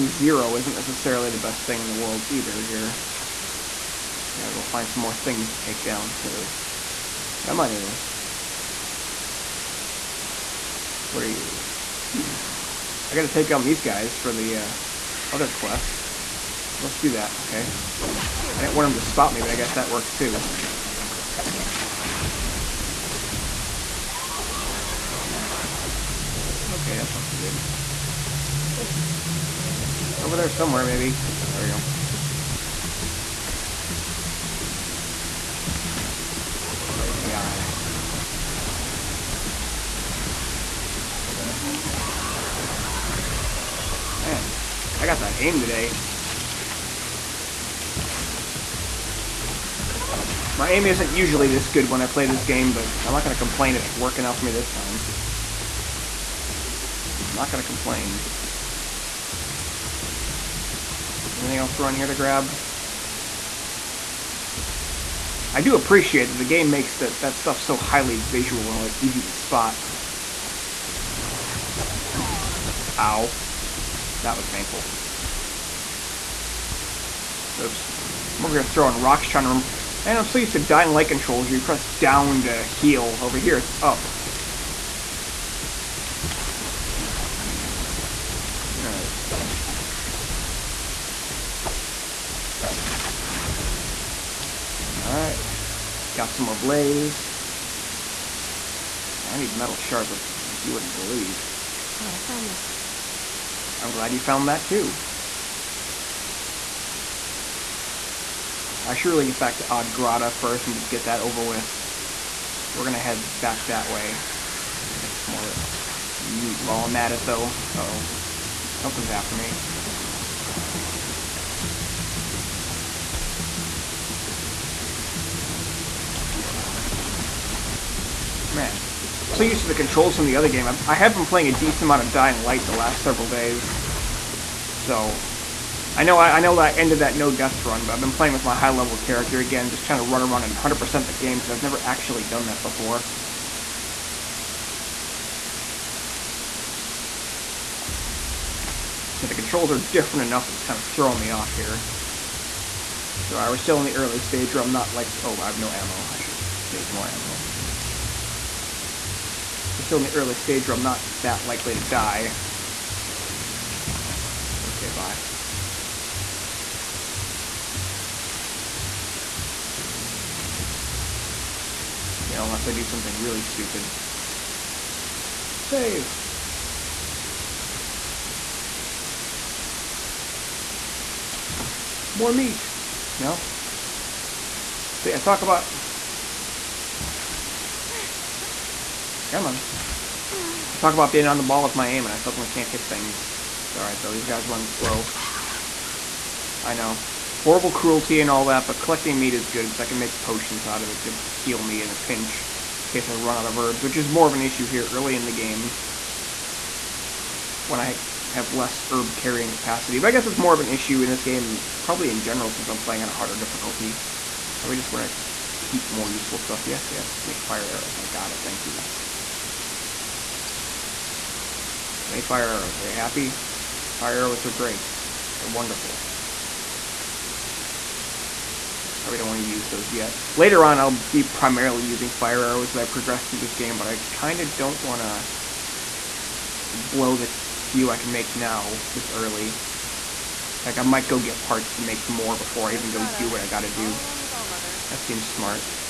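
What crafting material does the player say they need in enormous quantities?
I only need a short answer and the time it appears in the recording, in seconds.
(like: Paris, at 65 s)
metal shards, at 99 s.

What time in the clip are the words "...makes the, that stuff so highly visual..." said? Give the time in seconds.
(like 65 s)
66 s.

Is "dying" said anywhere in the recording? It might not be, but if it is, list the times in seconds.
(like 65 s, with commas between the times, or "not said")
80 s, 132 s.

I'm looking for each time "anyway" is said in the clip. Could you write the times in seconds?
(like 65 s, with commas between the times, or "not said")
7 s.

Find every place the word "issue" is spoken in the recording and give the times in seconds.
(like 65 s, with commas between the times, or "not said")
204 s, 210 s.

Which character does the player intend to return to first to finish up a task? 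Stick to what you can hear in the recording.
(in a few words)
Old Grata.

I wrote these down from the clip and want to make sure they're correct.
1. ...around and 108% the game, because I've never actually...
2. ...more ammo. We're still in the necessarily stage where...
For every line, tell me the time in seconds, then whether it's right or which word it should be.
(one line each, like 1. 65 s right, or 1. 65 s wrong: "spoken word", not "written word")
1. 140 s wrong: "100", not "108"
2. 156 s wrong: "early", not "necessarily".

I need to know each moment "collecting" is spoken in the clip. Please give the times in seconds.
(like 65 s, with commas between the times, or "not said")
198 s.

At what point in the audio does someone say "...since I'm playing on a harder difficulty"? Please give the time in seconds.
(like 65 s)
212 s.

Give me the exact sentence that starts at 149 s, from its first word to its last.
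But the controls are different enough that's kind of throwing me off here.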